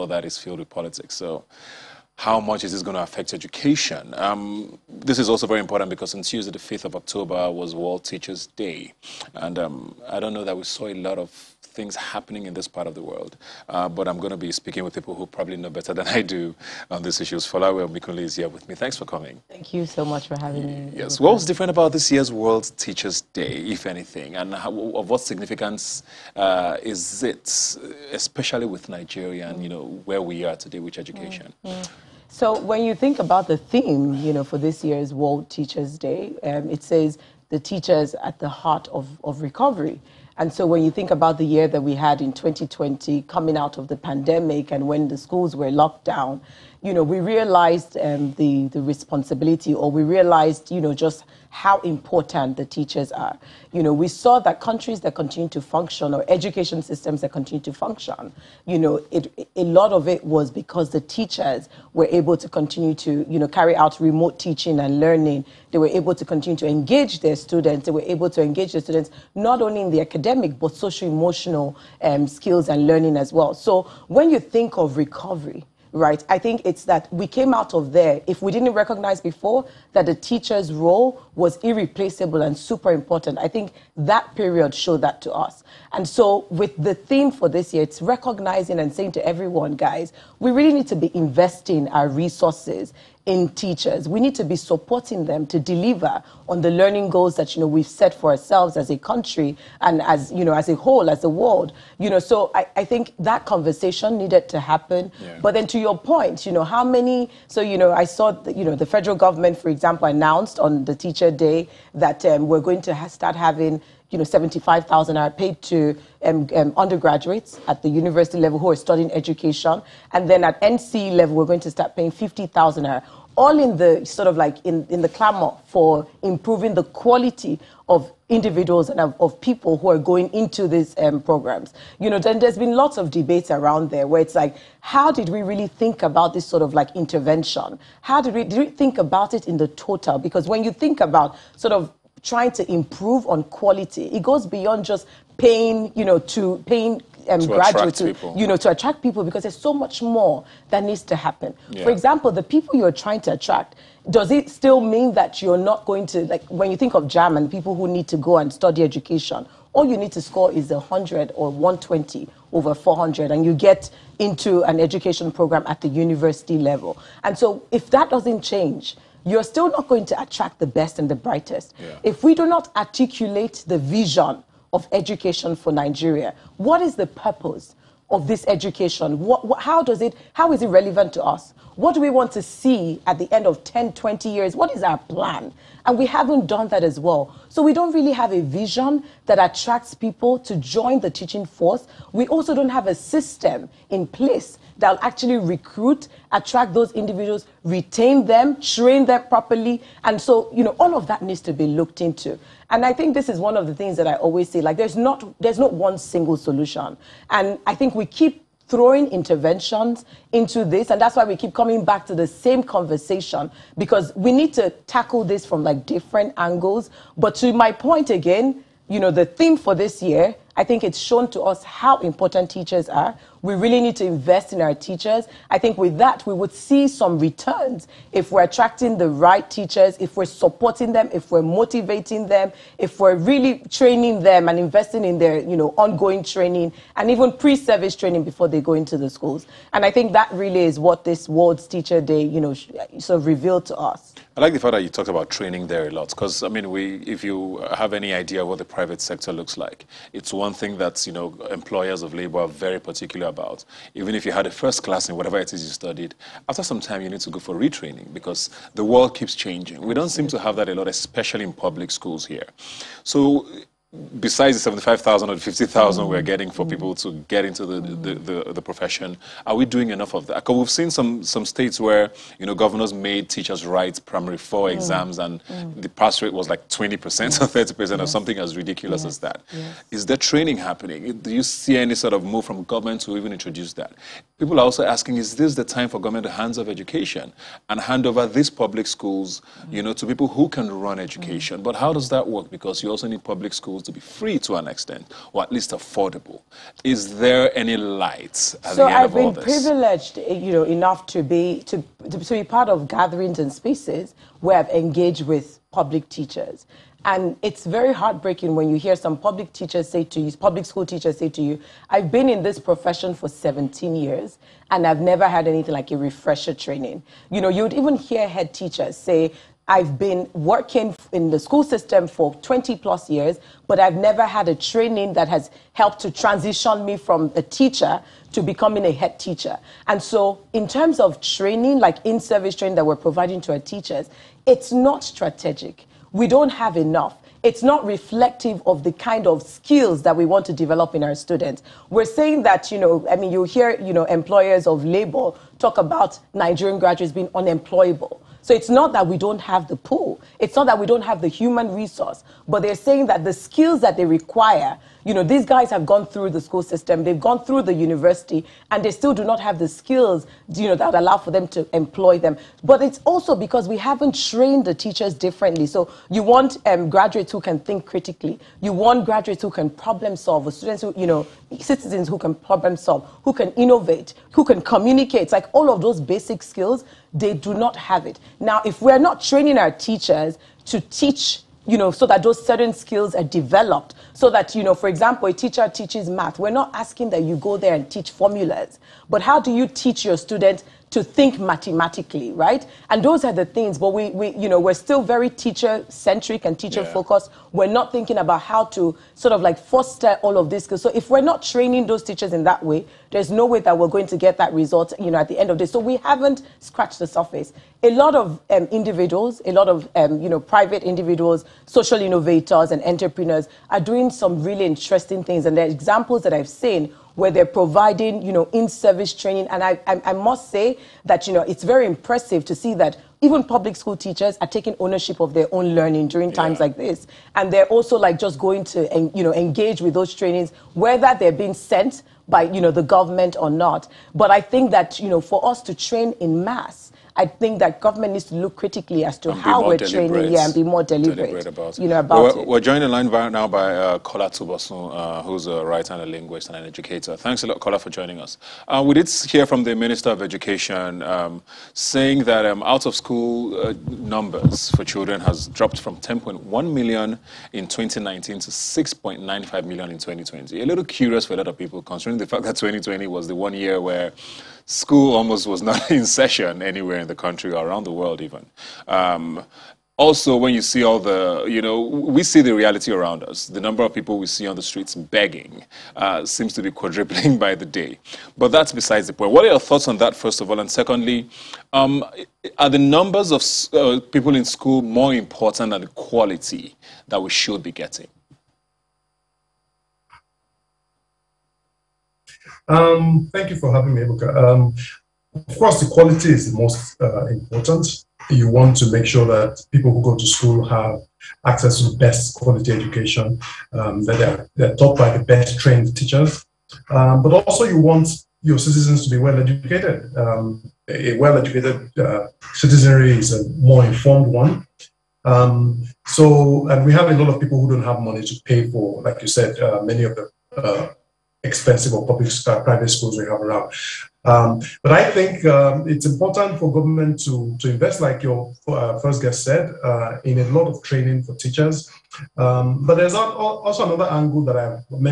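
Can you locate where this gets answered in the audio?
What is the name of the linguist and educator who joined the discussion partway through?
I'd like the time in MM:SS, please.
07:23.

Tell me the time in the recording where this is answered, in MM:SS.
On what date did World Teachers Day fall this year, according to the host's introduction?
00:06.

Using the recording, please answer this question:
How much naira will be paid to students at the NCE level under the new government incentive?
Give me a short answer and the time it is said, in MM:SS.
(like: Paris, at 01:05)
50,000 naira, at 02:02.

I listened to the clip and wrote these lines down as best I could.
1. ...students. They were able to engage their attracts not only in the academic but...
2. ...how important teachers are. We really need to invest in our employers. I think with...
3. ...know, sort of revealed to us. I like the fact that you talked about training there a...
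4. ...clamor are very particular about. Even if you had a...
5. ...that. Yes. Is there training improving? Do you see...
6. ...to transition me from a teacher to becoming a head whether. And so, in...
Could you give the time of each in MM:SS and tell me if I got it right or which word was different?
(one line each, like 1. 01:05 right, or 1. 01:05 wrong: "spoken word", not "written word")
1. 01:07 wrong: "students", not "attracts"
2. 03:41 wrong: "teachers", not "employers"
3. 04:02 right
4. 04:12 wrong: "labor", not "clamor"
5. 04:39 wrong: "happening", not "improving"
6. 05:26 wrong: "teacher", not "whether".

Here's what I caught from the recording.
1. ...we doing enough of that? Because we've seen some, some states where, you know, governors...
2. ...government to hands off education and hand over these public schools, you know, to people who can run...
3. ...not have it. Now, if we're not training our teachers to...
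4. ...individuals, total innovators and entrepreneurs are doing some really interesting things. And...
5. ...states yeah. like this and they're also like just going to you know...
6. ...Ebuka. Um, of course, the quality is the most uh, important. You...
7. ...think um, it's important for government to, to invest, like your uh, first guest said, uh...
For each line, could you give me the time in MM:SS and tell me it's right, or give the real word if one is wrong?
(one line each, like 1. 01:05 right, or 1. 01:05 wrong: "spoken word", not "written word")
1. 04:29 right
2. 04:45 right
3. 06:17 right
4. 06:50 wrong: "social", not "total"
5. 07:06 wrong: "times", not "states"
6. 08:14 right
7. 08:45 right.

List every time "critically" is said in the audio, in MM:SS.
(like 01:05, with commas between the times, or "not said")
06:07, 07:18.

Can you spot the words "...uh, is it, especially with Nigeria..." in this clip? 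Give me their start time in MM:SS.
00:26.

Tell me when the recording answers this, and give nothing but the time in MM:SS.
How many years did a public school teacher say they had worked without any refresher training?
05:13.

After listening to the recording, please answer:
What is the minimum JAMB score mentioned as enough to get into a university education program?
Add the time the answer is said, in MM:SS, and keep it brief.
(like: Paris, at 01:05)
100, at 02:40.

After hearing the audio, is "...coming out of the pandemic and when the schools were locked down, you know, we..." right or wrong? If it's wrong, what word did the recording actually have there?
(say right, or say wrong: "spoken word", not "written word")
right.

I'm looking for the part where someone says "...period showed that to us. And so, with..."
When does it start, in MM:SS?
01:24.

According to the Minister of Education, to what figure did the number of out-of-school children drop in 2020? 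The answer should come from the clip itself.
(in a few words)
6.95 million.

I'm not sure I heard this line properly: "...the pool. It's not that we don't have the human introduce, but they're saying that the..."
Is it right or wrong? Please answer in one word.
wrong.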